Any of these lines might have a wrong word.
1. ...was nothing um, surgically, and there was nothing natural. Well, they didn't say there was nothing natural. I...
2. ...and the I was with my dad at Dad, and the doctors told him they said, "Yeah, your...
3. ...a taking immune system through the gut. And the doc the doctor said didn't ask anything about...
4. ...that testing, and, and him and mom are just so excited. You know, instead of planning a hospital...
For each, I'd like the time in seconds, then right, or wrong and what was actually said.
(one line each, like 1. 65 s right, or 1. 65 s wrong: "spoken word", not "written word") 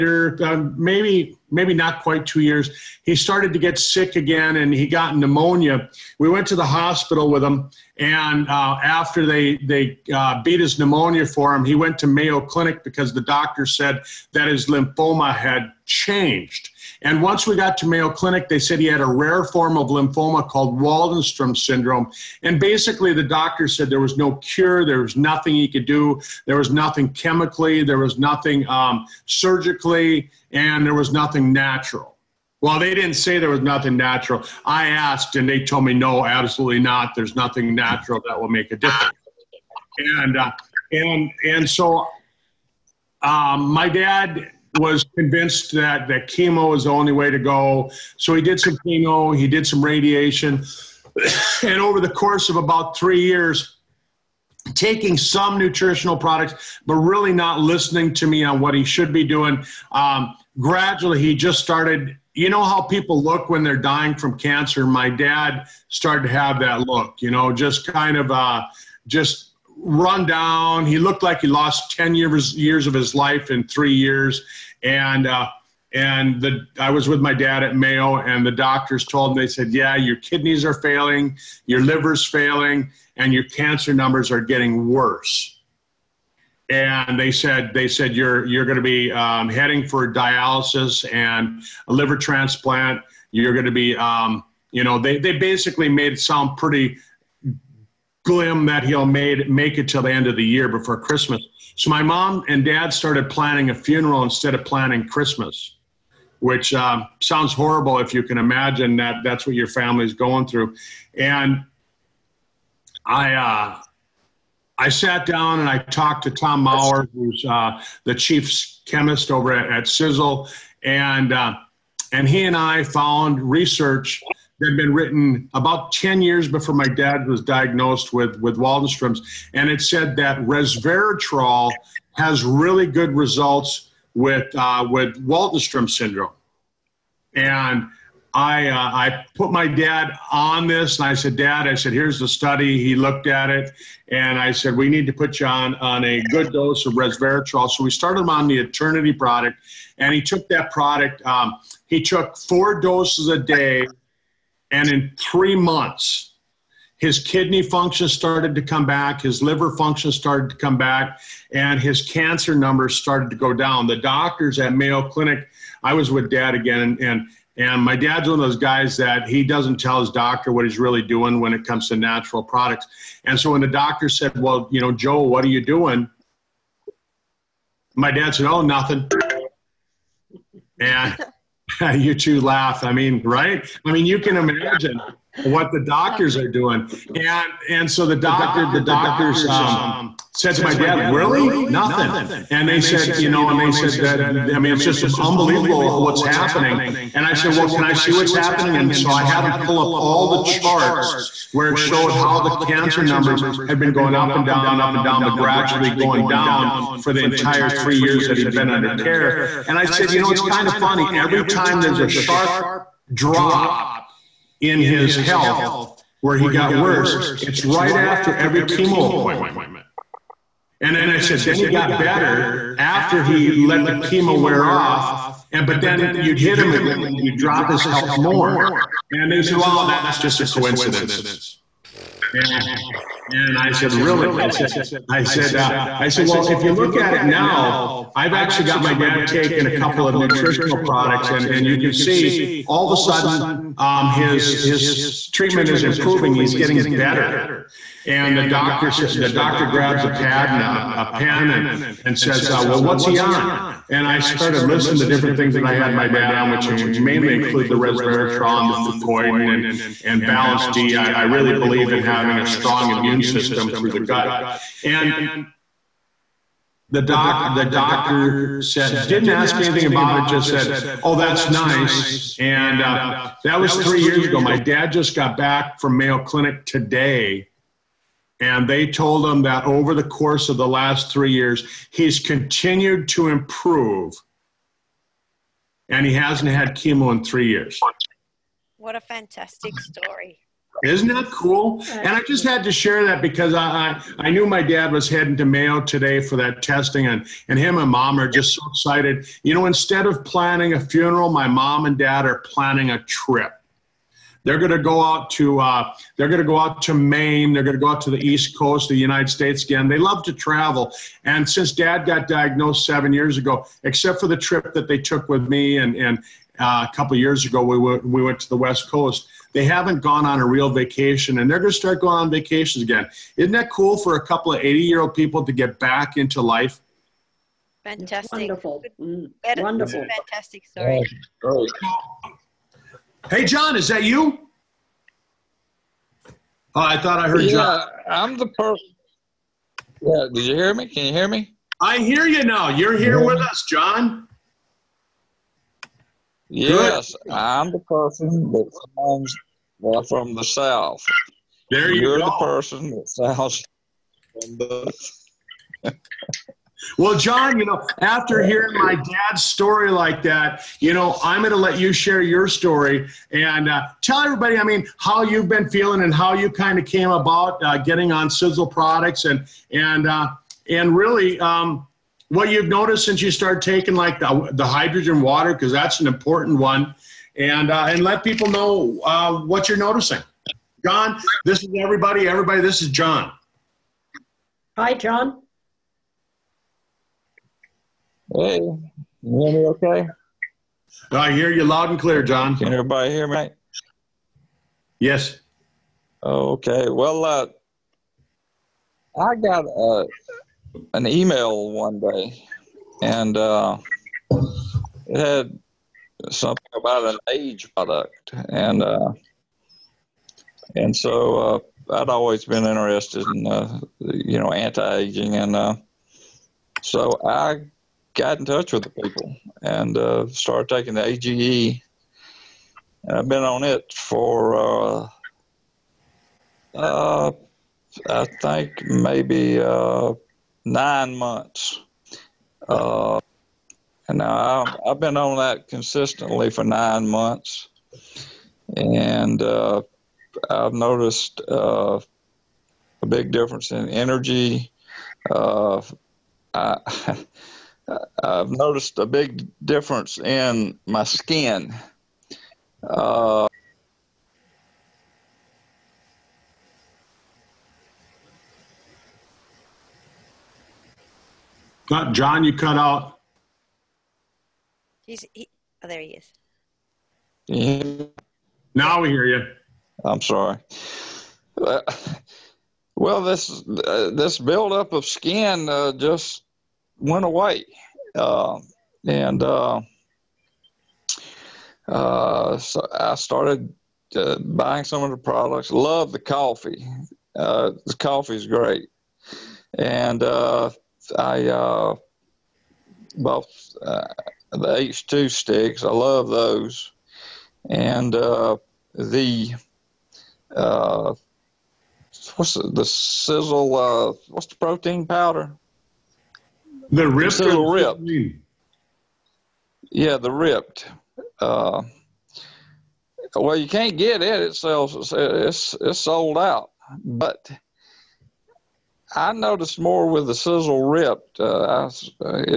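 1. 27 s right
2. 75 s wrong: "Mayo", not "Dad"
3. 262 s wrong: "strong", not "taking"
4. 296 s wrong: "funeral", not "hospital".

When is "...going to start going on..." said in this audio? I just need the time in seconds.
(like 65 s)
321 s.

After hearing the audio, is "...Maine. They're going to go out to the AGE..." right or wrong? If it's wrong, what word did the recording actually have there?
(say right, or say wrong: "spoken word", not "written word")
wrong: "East", not "AGE".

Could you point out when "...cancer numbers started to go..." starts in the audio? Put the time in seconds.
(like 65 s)
162 s.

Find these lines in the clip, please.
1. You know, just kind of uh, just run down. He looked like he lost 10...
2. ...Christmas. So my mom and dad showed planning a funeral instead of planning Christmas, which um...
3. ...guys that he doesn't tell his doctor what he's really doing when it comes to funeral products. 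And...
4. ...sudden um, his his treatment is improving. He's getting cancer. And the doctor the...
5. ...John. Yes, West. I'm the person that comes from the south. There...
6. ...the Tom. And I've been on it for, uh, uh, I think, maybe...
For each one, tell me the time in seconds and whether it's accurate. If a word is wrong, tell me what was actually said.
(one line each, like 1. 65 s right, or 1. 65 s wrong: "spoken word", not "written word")
1. 67 s right
2. 100 s wrong: "started", not "showed"
3. 168 s wrong: "natural", not "funeral"
4. 242 s wrong: "better", not "cancer"
5. 343 s wrong: "Good", not "West"
6. 420 s wrong: "AGE", not "Tom".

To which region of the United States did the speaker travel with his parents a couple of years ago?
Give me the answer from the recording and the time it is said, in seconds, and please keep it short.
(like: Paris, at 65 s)
West Coast, at 318 s.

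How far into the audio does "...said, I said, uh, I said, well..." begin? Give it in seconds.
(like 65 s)
234 s.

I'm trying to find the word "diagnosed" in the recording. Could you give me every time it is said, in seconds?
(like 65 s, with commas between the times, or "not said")
127 s, 312 s.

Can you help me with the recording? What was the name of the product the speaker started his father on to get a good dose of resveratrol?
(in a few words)
Eternity.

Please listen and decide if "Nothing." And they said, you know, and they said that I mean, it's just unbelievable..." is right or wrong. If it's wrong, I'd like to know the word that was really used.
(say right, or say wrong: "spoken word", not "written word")
right.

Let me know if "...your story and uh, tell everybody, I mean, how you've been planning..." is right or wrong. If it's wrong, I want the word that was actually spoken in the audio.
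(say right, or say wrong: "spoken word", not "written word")
wrong: "feeling", not "planning".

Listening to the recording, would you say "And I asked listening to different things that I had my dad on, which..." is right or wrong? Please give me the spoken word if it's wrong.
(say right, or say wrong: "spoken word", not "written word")
wrong: "started", not "asked".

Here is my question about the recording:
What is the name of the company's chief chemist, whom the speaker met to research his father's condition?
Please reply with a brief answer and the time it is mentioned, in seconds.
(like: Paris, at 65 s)
Tom Maurer, at 116 s.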